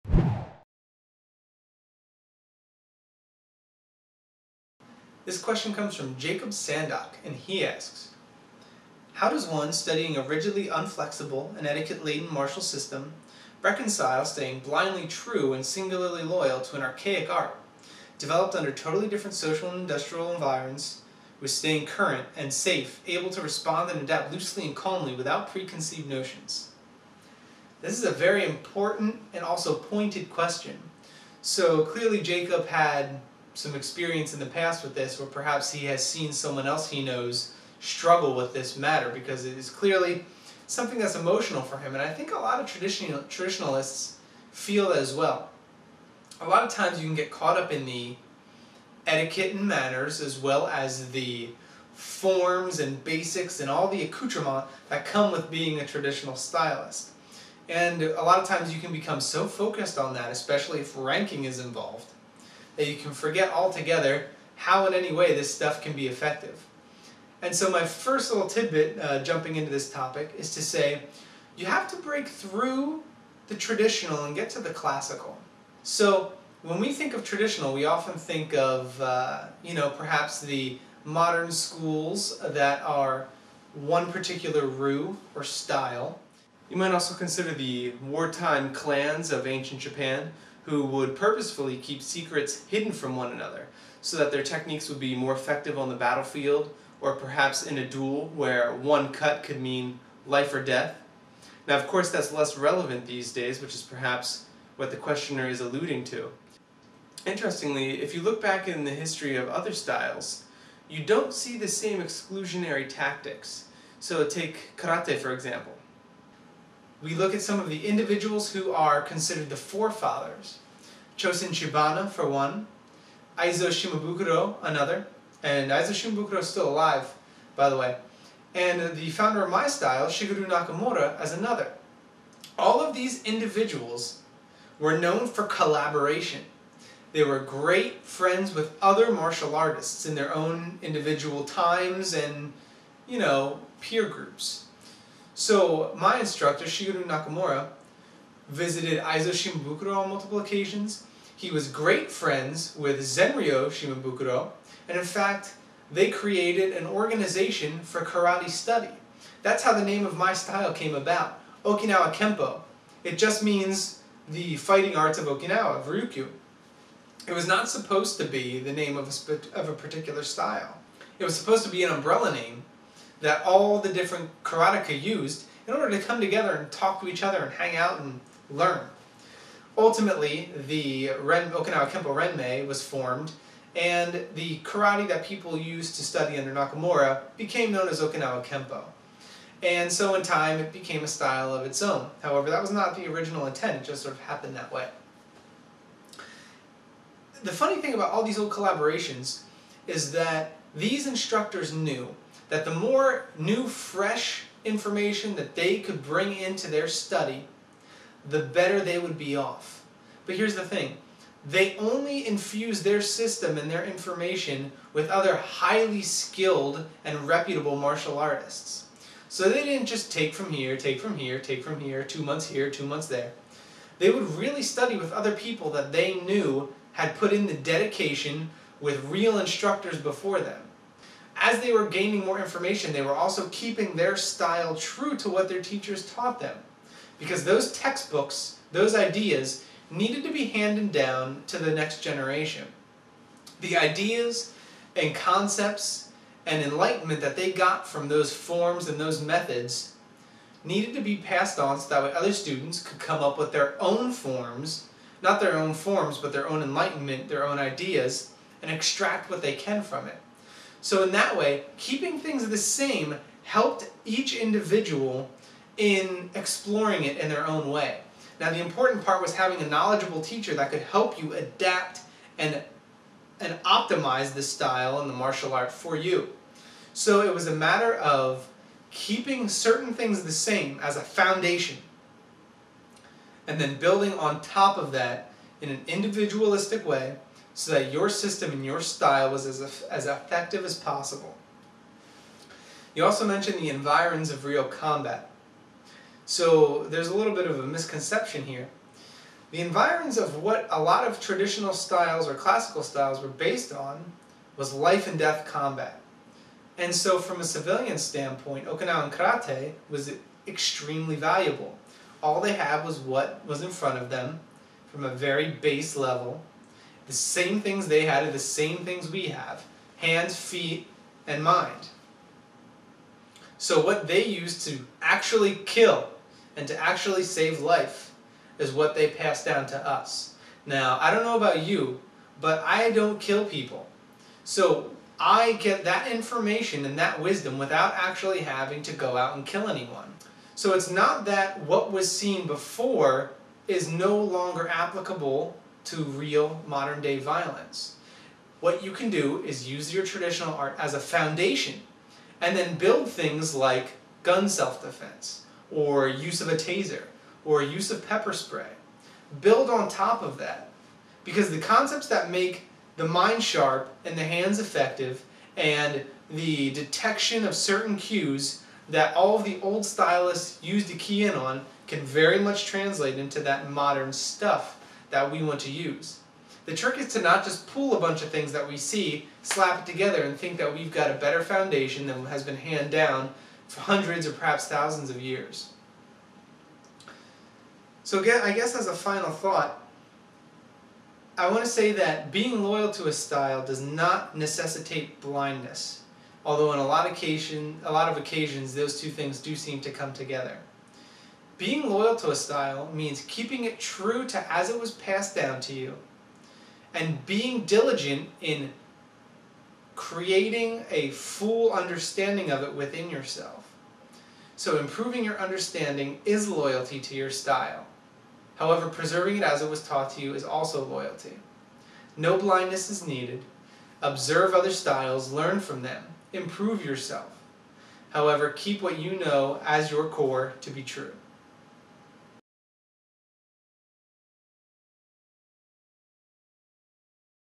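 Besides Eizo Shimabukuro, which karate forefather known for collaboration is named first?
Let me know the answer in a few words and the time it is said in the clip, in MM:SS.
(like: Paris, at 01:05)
Chosin Chibana, at 02:01.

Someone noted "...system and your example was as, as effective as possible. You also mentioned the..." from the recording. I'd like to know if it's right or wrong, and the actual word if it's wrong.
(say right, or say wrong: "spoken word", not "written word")
wrong: "style", not "example".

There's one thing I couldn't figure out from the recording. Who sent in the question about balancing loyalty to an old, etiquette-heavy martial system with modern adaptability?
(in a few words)
Jacob Sandok.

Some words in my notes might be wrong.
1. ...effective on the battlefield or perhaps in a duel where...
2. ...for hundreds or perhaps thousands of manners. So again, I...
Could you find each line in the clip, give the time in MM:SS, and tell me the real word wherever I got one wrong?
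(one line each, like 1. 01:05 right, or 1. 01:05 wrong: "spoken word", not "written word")
1. 01:35 right
2. 06:23 wrong: "years", not "manners".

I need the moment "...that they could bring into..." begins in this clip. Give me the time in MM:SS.
03:25.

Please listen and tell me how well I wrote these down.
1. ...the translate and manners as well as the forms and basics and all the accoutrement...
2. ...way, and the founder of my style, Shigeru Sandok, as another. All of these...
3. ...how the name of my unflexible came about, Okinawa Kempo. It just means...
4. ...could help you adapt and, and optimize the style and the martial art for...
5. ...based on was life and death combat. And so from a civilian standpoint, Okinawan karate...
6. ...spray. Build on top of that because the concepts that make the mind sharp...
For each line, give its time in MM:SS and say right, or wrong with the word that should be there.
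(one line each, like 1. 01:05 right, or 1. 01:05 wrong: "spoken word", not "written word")
1. 00:47 wrong: "etiquette", not "translate"
2. 02:07 wrong: "Nakamura", not "Sandok"
3. 02:39 wrong: "style", not "unflexible"
4. 04:30 right
5. 05:03 right
6. 05:58 right.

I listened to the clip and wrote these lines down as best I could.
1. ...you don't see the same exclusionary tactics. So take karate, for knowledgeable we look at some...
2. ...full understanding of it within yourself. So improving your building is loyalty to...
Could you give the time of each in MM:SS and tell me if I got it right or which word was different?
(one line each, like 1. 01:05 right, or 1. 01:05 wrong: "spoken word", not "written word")
1. 01:50 wrong: "example", not "knowledgeable"
2. 06:51 wrong: "understanding", not "building".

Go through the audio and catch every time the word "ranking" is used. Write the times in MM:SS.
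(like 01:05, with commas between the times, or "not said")
01:00.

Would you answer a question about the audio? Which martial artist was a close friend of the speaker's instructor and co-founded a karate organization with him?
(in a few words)
Zenryo Shimabukuro.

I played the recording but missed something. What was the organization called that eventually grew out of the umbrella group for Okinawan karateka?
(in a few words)
Okinawa Kempo Renmei.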